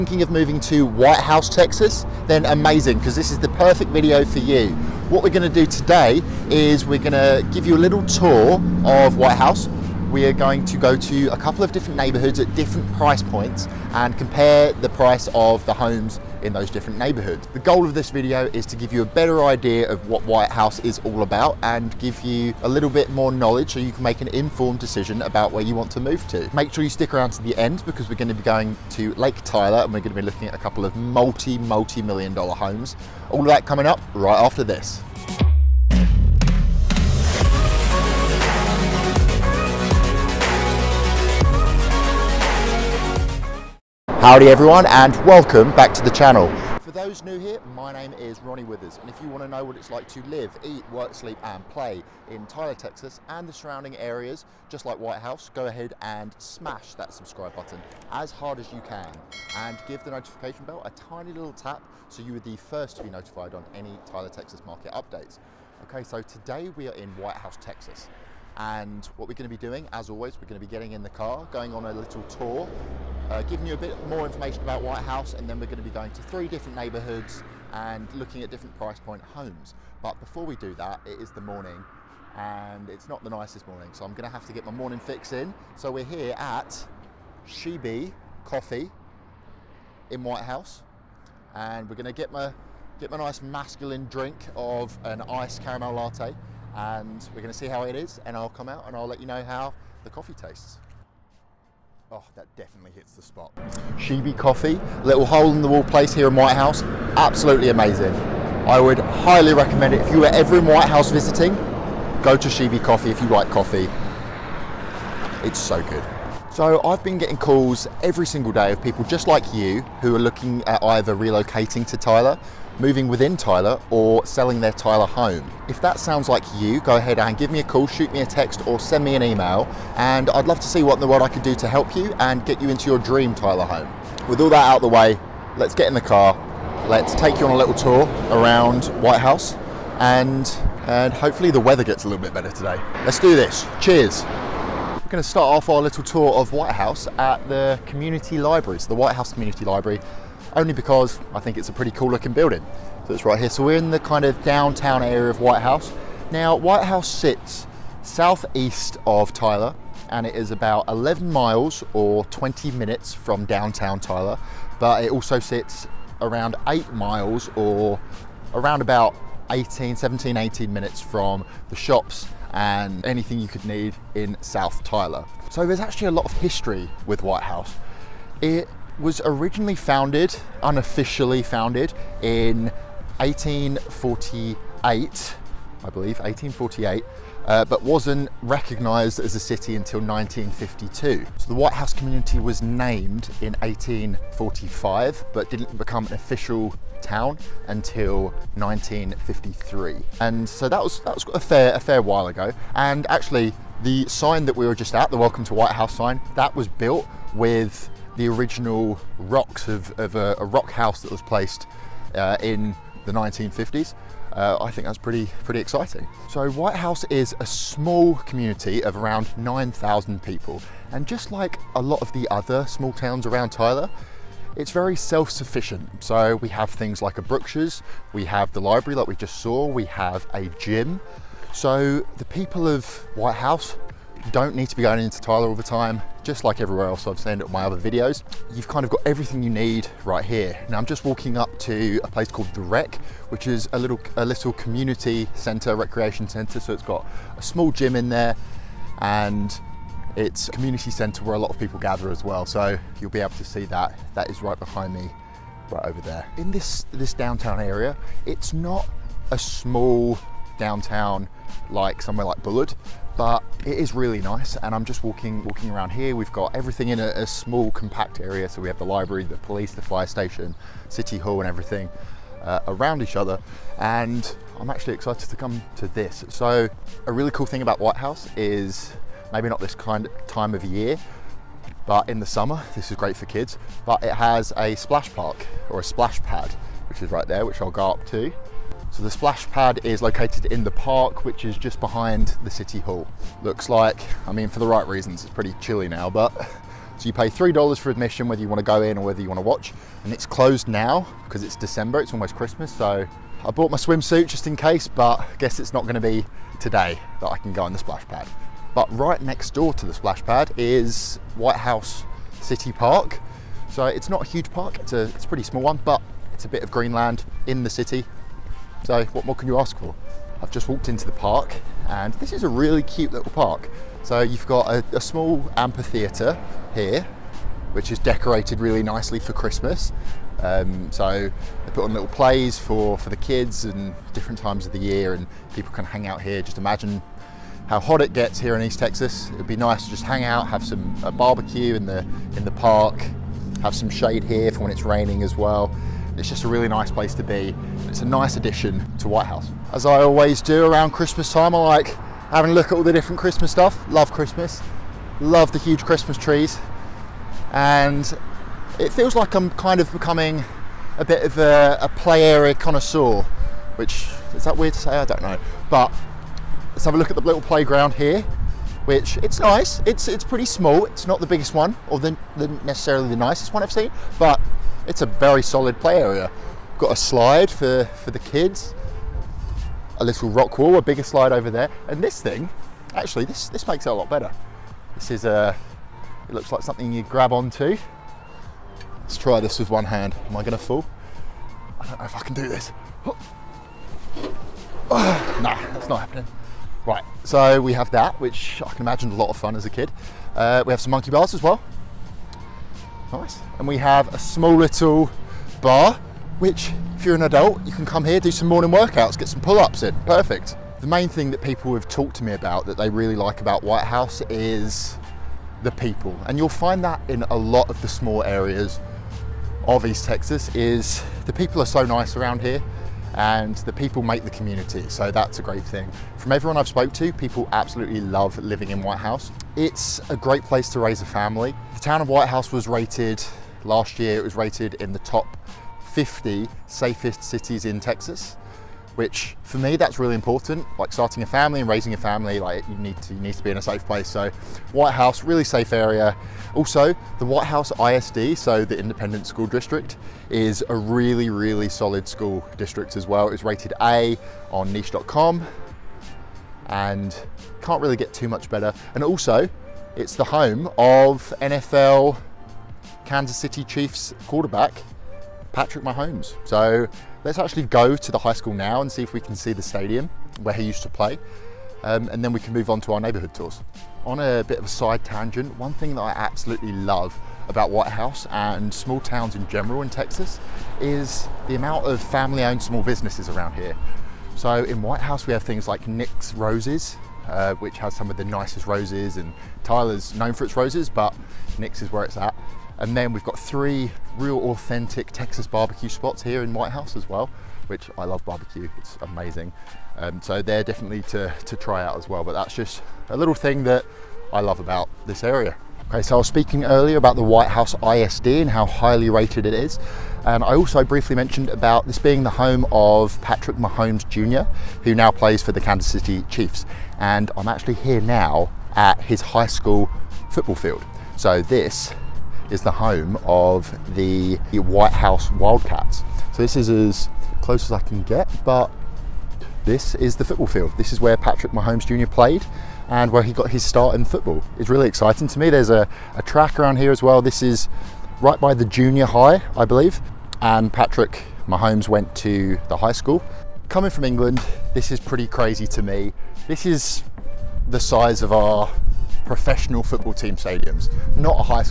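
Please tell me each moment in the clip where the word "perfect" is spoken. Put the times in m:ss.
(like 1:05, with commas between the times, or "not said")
0:03, 6:50.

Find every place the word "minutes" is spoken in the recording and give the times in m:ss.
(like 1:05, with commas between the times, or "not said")
2:42, 2:50.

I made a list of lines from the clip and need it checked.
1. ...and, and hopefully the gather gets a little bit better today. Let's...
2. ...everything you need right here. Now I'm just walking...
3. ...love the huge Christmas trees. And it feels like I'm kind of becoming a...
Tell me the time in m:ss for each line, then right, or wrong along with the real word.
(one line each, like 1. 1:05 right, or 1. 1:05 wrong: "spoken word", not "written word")
1. 2:19 wrong: "weather", not "gather"
2. 3:59 right
3. 5:55 right.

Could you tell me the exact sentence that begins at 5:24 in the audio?
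So you've got a, a small amphitheatre here, which is decorated really nicely for Christmas.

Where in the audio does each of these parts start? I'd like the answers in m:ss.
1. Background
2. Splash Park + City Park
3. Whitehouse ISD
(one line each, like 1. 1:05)
1. 2:24
2. 4:37
3. 8:25.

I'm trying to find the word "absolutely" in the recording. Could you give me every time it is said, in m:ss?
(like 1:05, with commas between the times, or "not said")
1:47, 7:07, 7:56.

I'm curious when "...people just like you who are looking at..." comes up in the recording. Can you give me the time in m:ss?
1:58.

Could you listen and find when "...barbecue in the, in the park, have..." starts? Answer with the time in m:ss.
5:41.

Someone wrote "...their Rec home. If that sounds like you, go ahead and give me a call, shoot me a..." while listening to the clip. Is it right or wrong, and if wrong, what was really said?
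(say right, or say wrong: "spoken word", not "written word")
wrong: "Tyler", not "Rec".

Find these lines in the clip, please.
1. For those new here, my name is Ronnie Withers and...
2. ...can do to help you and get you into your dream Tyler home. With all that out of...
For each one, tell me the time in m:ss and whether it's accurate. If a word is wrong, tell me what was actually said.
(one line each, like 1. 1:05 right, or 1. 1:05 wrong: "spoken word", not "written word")
1. 0:46 right
2. 2:11 right.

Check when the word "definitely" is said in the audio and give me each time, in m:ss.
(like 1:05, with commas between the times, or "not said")
1:42, 8:20.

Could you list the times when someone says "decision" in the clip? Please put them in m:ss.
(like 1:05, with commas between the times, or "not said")
0:24.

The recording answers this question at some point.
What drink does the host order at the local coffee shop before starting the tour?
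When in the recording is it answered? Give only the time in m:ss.
1:35.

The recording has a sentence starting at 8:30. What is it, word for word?
And I also briefly mentioned about this being the home of Patrick Mahomes Jr., who now plays for the Kansas City Chiefs.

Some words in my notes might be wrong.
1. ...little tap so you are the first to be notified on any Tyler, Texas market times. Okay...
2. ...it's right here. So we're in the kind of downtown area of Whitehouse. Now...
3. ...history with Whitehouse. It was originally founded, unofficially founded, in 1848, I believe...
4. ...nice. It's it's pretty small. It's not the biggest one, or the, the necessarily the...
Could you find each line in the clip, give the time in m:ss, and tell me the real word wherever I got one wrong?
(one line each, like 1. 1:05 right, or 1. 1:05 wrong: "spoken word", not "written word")
1. 1:01 wrong: "updates", not "times"
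2. 2:33 right
3. 2:56 right
4. 6:09 right.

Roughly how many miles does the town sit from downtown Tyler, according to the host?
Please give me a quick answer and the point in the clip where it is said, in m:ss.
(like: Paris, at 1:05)
11 miles, at 2:40.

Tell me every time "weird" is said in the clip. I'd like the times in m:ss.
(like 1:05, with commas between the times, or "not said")
6:04.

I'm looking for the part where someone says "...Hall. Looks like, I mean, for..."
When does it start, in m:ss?
4:52.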